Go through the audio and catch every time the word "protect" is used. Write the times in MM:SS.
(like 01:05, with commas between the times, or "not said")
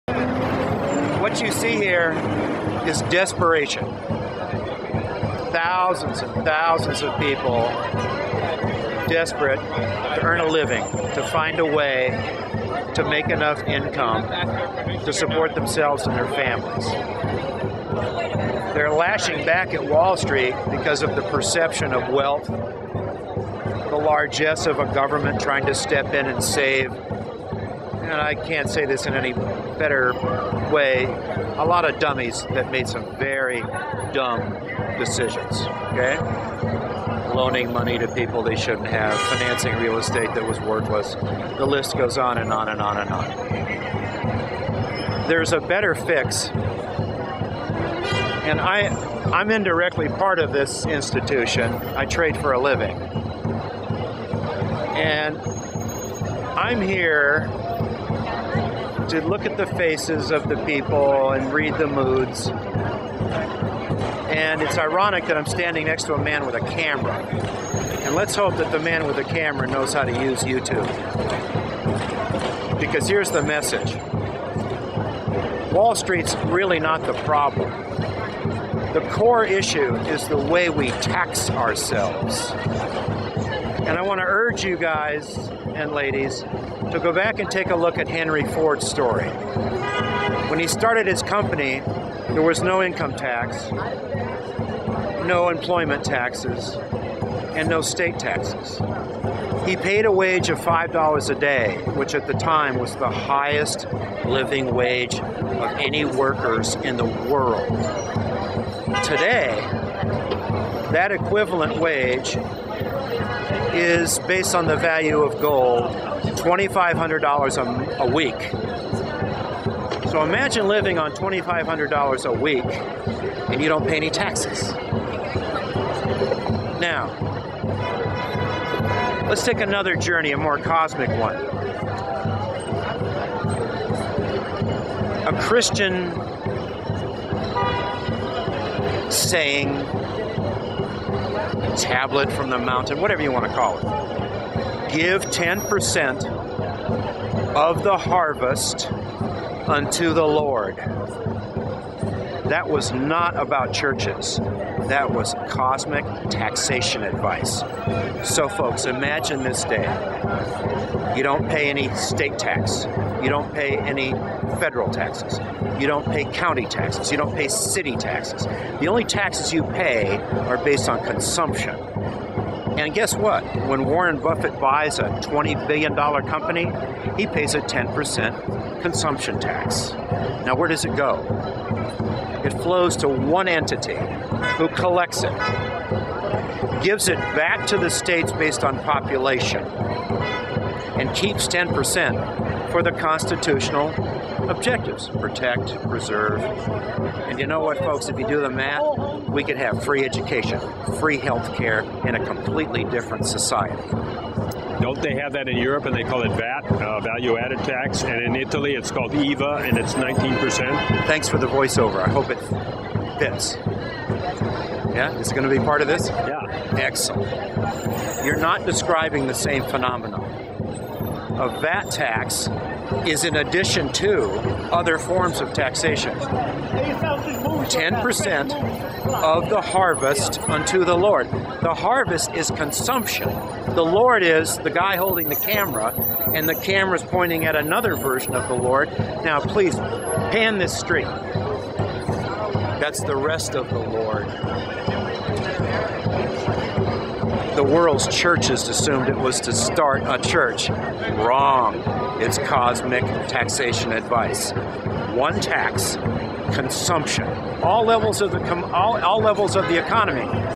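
03:15.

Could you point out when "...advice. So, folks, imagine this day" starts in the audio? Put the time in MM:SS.
02:37.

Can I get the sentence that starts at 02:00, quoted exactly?
So imagine living on $2,500 a week and you don't pay any taxes.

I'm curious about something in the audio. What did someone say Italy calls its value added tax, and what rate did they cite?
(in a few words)
IVA, 19%.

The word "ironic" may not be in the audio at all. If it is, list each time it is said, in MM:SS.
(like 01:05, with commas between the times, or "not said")
01:04.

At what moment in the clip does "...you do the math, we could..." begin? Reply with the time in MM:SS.
03:18.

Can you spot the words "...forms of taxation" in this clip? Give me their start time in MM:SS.
03:44.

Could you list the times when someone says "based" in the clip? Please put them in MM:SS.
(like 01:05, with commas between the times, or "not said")
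01:54, 02:50, 03:08.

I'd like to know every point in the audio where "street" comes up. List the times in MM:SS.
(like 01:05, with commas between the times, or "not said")
00:20, 01:15, 04:00.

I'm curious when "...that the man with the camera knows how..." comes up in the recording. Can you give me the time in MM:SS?
01:08.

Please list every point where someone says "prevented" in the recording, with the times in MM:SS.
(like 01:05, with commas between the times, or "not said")
not said.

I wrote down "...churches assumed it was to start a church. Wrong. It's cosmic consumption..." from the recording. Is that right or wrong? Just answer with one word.
wrong.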